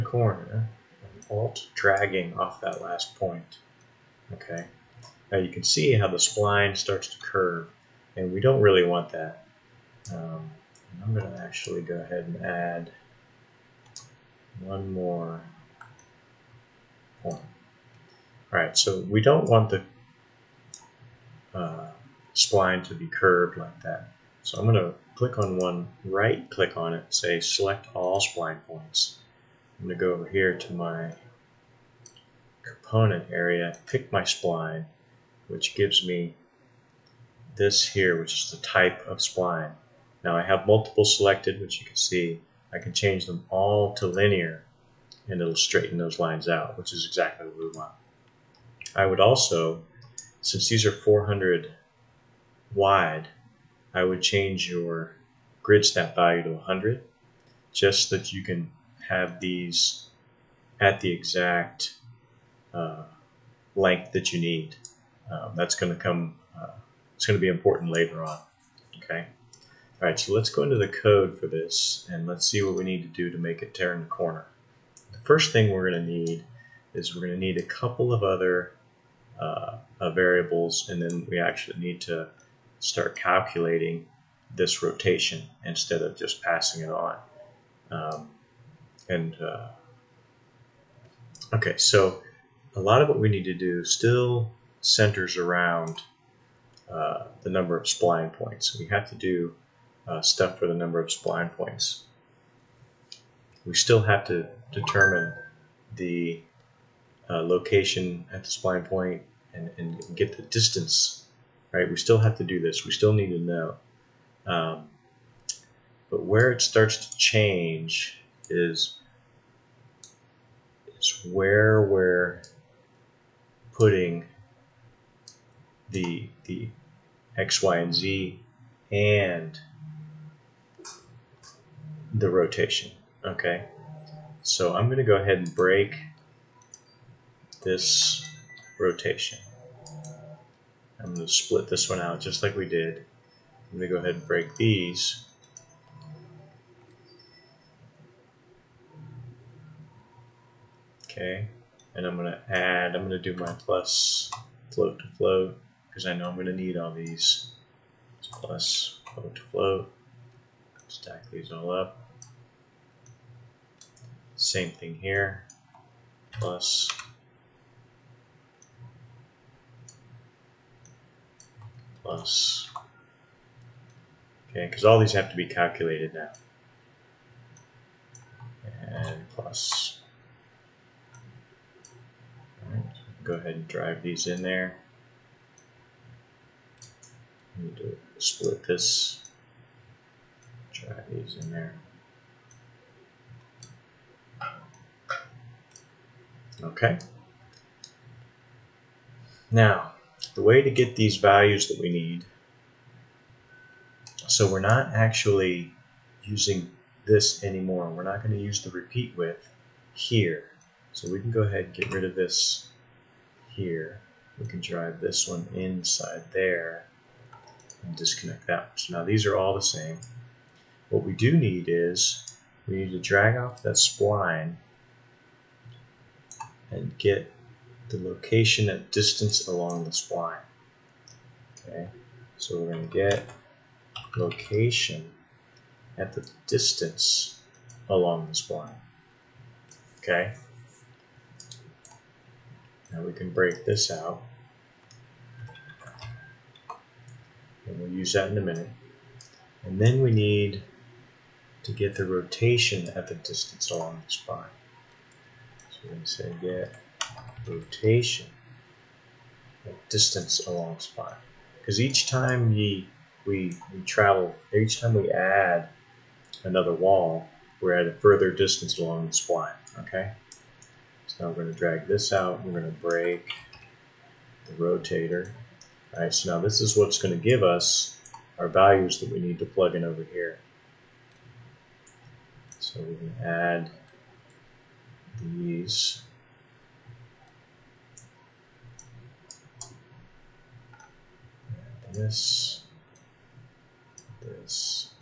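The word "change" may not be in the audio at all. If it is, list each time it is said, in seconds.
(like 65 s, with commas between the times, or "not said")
42 s, 54 s, 117 s.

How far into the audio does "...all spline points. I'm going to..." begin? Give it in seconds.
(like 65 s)
27 s.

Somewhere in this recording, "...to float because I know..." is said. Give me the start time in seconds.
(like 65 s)
154 s.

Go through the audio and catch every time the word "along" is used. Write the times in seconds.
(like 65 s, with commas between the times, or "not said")
229 s, 237 s, 253 s, 260 s, 268 s.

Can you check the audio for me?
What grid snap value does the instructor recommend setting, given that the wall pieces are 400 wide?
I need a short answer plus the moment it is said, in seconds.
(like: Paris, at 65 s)
100, at 56 s.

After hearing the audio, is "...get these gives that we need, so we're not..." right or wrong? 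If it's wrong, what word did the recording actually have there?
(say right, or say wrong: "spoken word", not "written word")
wrong: "values", not "gives".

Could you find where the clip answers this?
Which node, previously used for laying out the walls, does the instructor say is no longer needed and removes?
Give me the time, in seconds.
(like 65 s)
208 s.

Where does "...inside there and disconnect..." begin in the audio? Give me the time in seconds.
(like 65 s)
215 s.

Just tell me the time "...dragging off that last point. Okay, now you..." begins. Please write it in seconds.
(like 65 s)
1 s.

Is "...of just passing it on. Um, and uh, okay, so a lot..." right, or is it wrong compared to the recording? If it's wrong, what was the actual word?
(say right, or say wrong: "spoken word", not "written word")
right.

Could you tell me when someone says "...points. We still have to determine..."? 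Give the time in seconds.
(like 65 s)
101 s.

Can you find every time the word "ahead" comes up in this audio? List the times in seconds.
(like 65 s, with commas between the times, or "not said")
12 s, 135 s, 144 s, 183 s, 211 s.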